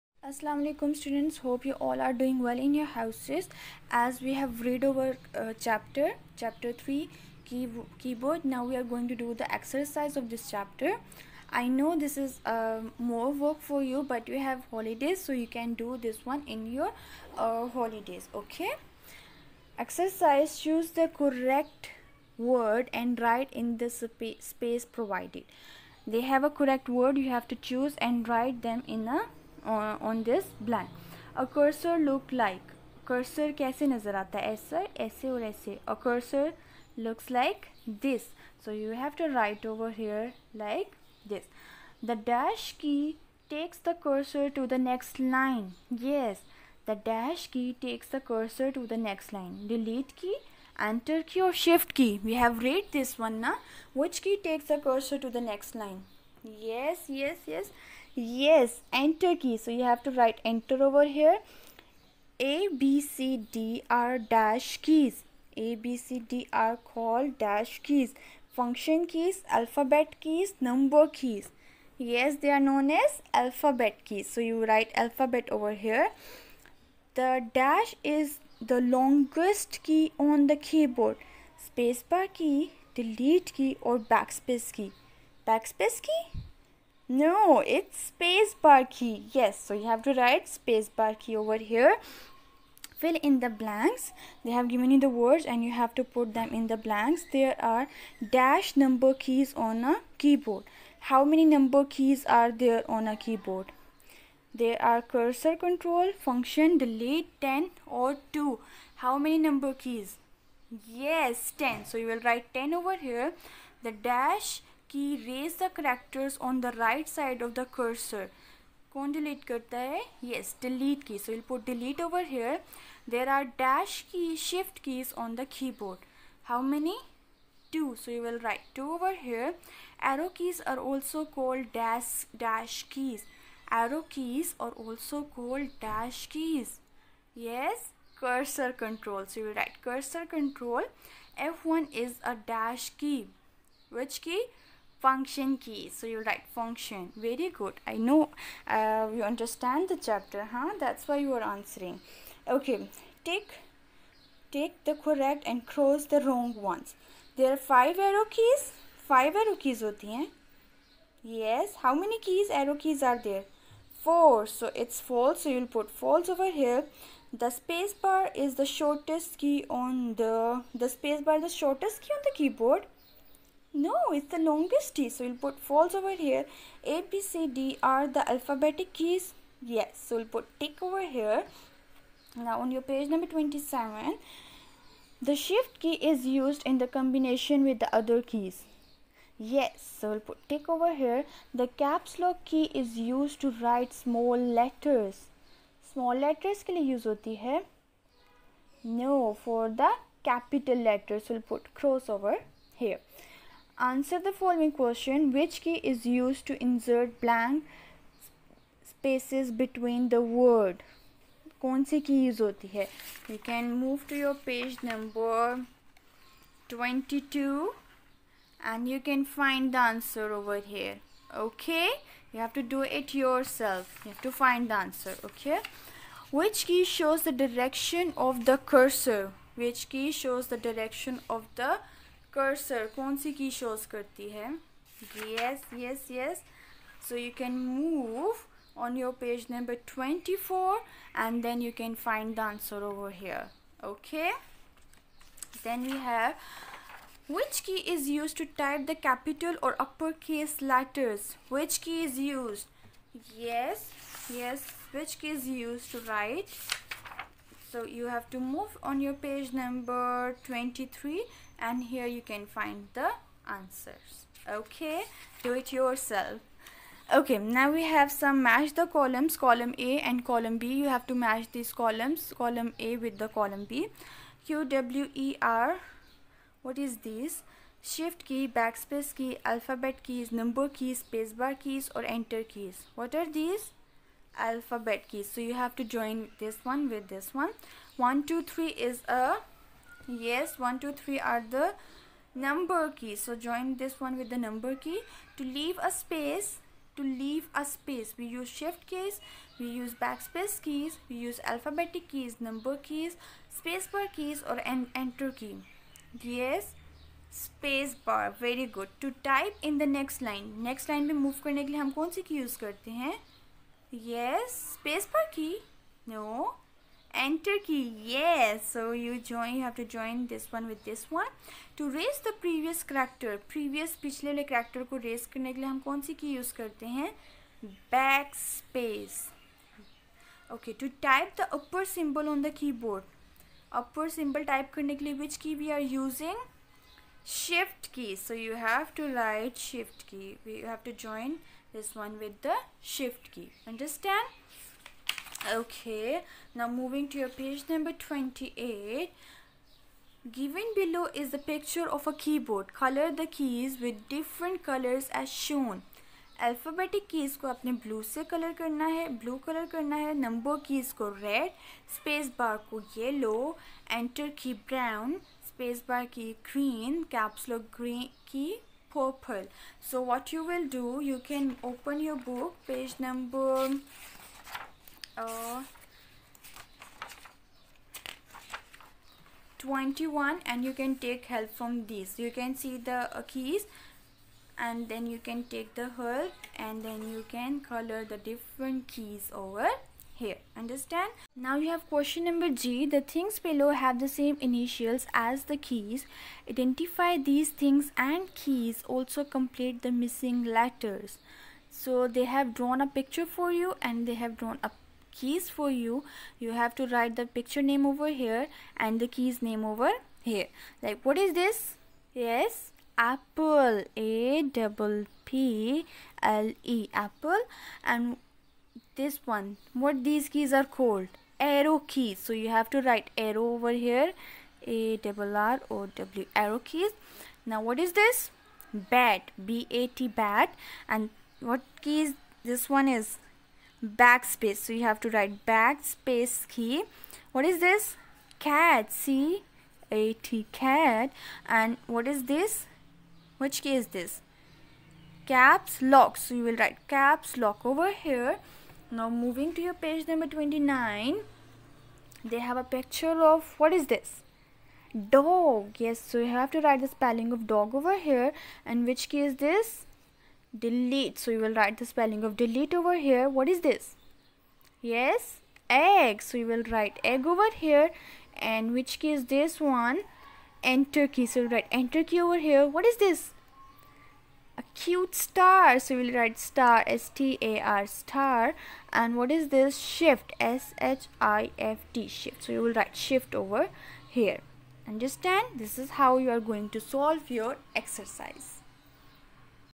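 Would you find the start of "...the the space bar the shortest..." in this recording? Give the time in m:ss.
2:50.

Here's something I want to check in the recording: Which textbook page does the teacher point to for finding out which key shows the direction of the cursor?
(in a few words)
24.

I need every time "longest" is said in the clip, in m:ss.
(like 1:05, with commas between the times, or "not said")
1:18, 2:54.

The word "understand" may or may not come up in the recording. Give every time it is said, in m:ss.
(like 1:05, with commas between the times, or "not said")
2:29, 5:43, 6:30, 8:04.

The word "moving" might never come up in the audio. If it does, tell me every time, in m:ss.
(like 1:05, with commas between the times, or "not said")
5:46, 7:29.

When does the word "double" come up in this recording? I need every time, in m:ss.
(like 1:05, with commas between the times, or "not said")
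6:54, 7:04.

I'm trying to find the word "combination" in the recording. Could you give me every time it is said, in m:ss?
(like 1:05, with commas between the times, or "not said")
3:06.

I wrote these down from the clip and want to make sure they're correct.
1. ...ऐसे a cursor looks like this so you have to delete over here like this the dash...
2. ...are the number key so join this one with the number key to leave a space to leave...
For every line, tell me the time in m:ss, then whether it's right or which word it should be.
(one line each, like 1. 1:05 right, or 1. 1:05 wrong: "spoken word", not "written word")
1. 0:35 wrong: "write", not "delete"
2. 4:51 right.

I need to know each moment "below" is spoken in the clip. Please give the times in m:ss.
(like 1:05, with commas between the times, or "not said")
5:50, 6:33.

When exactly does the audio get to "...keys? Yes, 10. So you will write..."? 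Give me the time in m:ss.
1:49.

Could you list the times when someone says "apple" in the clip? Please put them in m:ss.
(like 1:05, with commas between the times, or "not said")
6:53, 6:57.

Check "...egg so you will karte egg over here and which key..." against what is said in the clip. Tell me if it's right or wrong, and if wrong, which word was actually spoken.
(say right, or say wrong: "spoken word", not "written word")
wrong: "write", not "karte".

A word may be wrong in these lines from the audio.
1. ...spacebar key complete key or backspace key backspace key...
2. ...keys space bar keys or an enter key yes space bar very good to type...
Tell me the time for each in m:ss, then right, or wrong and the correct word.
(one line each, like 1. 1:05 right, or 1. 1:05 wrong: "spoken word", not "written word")
1. 1:21 wrong: "delete", not "complete"
2. 5:02 right.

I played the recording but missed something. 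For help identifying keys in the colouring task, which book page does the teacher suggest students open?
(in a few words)
21.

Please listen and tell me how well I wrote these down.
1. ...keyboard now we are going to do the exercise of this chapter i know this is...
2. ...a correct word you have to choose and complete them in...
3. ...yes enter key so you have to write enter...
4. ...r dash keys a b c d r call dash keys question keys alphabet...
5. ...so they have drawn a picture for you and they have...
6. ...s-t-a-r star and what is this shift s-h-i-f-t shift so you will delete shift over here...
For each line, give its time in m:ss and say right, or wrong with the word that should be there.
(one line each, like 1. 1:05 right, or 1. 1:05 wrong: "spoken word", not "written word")
1. 0:08 right
2. 0:26 wrong: "write", not "complete"
3. 0:58 right
4. 1:03 wrong: "function", not "question"
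5. 6:41 right
6. 7:56 wrong: "write", not "delete".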